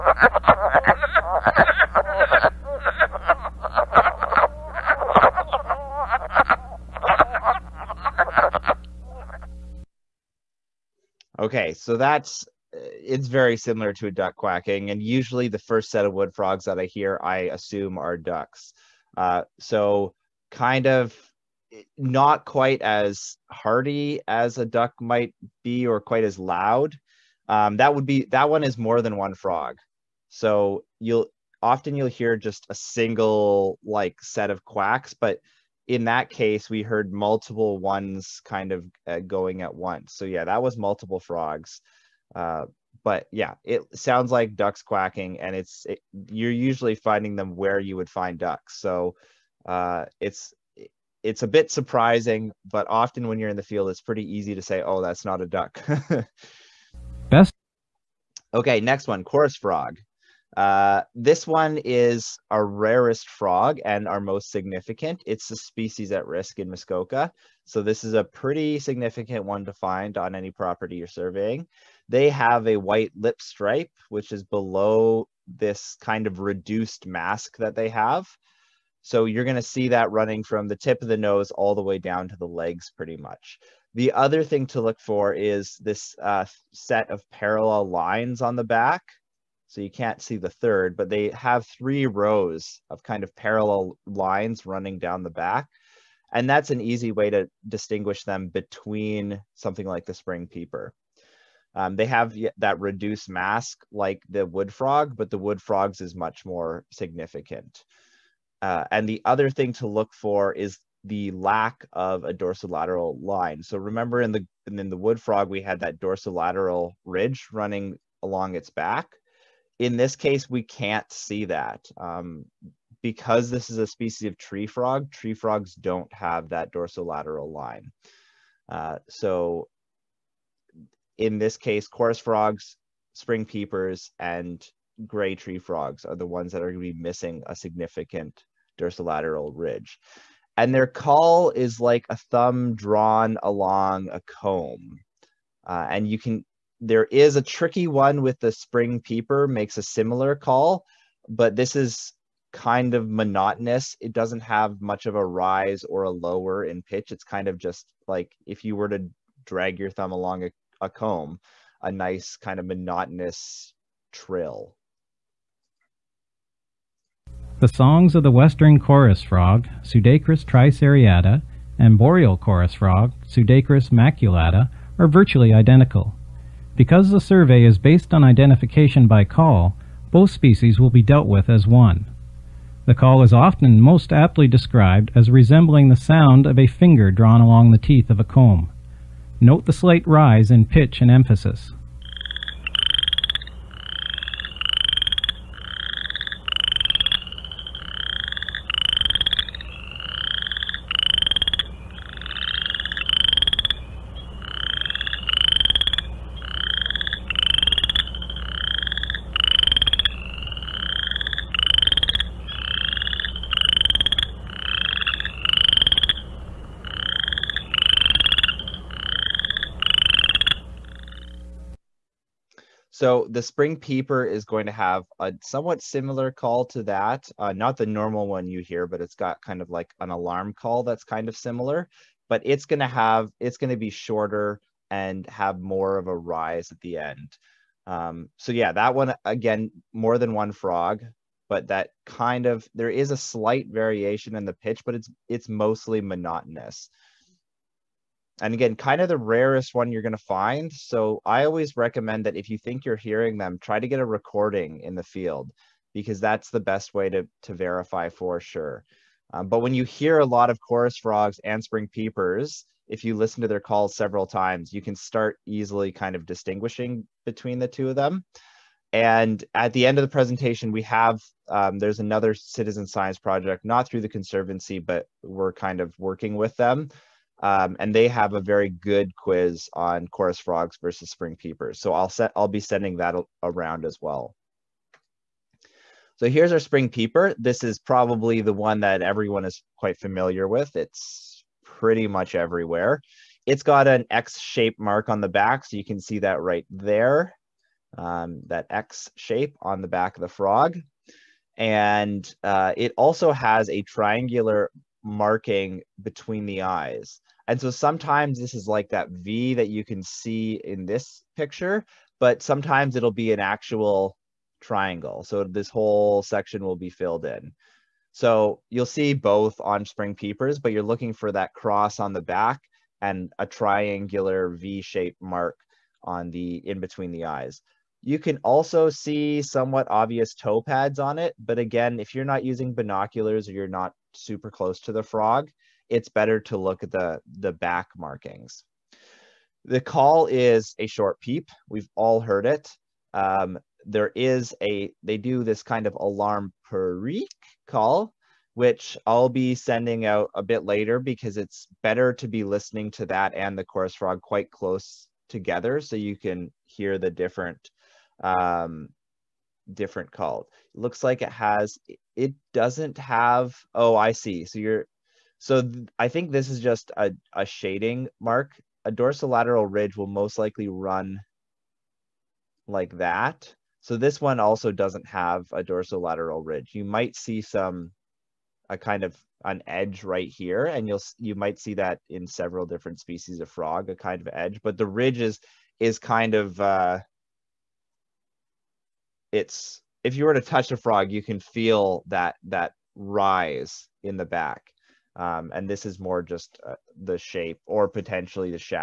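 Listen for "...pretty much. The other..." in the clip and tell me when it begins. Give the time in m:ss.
1:22.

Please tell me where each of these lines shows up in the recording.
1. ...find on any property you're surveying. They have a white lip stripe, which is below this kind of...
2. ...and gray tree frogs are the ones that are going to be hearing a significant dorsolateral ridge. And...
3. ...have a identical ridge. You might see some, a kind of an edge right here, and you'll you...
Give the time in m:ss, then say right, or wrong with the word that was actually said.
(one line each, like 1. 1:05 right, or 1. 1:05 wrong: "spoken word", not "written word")
1. 1:09 right
2. 2:14 wrong: "missing", not "hearing"
3. 6:15 wrong: "dorsolateral", not "identical".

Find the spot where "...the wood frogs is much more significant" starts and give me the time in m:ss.
1:45.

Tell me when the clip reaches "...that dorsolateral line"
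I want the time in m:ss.
2:06.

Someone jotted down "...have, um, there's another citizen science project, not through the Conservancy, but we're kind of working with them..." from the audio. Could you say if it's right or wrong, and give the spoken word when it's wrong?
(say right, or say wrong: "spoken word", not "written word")
right.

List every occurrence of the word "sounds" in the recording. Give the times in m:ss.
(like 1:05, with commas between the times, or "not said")
0:43, 3:05.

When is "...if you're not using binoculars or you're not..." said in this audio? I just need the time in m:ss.
5:31.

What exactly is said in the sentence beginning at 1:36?
And that's an easy way to distinguish them between something like the spring peeper.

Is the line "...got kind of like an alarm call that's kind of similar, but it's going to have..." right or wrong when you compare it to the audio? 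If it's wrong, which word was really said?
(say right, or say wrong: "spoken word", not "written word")
right.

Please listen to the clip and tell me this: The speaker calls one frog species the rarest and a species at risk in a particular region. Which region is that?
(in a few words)
Muskoka.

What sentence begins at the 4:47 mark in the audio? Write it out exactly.
This is probably the one that everyone is quite familiar with.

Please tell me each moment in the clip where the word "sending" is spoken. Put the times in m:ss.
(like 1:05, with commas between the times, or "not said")
4:42, 5:49.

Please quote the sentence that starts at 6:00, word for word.
It looks like it has, it doesn't have, oh, I see.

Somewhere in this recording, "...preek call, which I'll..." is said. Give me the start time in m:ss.
5:46.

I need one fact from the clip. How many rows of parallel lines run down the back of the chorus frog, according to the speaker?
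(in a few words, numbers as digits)
3.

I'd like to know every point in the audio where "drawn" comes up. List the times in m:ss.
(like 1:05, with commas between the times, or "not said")
2:22, 3:07.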